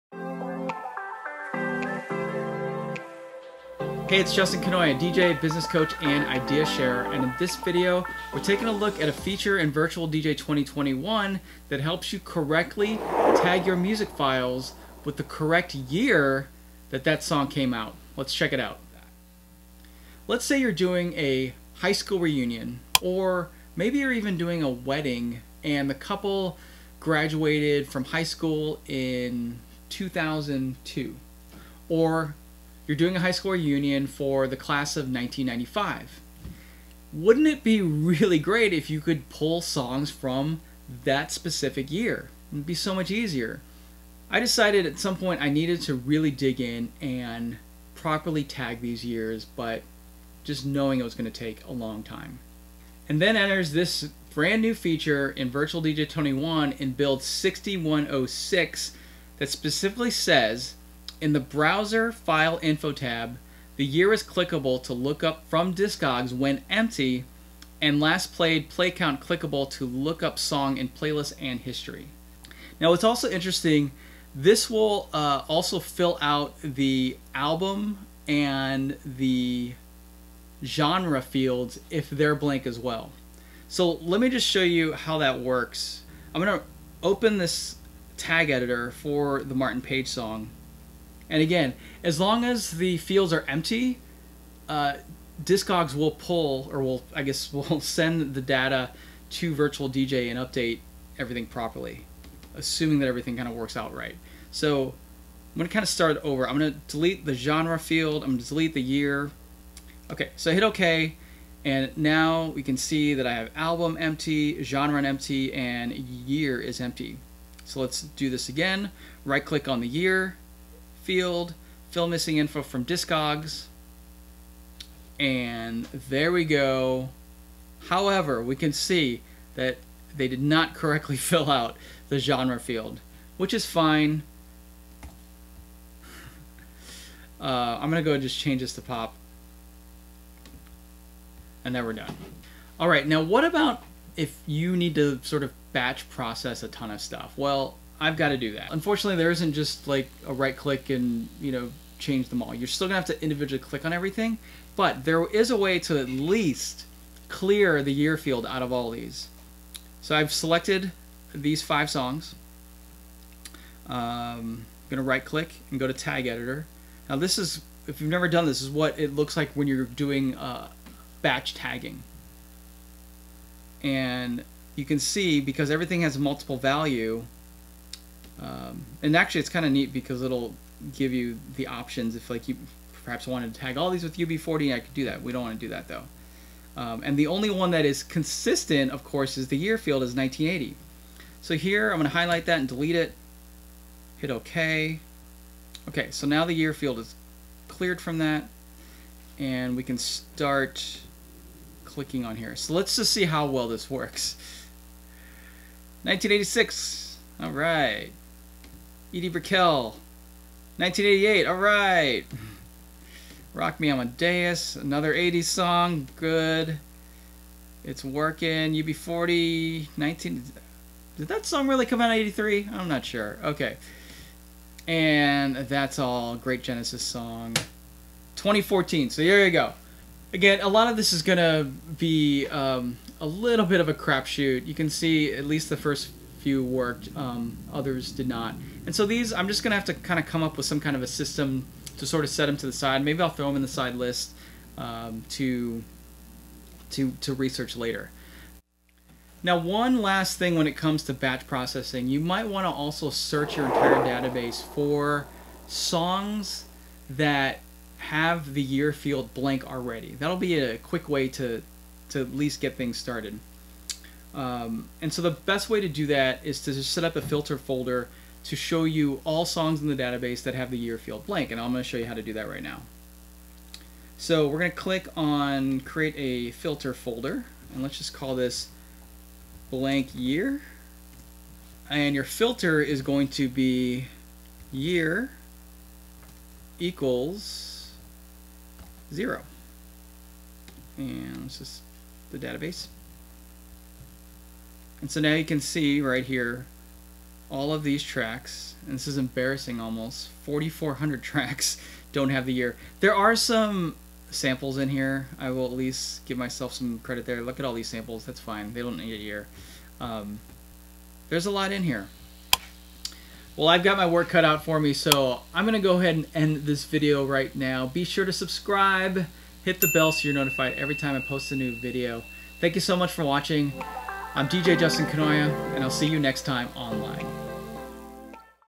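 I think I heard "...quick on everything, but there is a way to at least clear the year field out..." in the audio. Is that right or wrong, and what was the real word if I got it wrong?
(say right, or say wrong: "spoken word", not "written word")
wrong: "click", not "quick".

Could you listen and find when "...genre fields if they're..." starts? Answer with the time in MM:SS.
01:20.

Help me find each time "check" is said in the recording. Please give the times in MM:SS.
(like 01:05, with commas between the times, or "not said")
00:18.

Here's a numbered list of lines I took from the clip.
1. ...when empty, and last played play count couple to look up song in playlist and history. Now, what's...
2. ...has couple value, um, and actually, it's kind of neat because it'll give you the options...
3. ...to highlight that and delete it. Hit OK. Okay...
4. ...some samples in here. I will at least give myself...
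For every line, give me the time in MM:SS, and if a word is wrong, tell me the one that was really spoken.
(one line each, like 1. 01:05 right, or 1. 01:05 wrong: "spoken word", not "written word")
1. 01:06 wrong: "clickable", not "couple"
2. 02:56 wrong: "multiple", not "couple"
3. 03:12 right
4. 05:03 right.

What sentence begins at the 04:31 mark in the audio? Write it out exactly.
And I'm going to show you how to do that right now.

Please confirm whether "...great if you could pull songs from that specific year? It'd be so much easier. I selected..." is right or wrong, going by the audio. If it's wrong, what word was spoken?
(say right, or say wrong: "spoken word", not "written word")
wrong: "decided", not "selected".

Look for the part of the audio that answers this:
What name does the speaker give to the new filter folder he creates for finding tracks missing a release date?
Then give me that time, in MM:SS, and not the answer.
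04:39.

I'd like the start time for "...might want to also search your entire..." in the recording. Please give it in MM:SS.
04:12.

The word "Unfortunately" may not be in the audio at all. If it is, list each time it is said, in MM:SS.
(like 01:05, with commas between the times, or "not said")
02:28.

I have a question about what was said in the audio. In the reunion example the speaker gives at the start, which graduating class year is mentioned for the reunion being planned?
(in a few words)
1995.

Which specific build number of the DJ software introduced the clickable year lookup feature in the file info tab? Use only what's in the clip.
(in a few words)
6106.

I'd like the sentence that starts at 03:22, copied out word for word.
So let's just see how well this works.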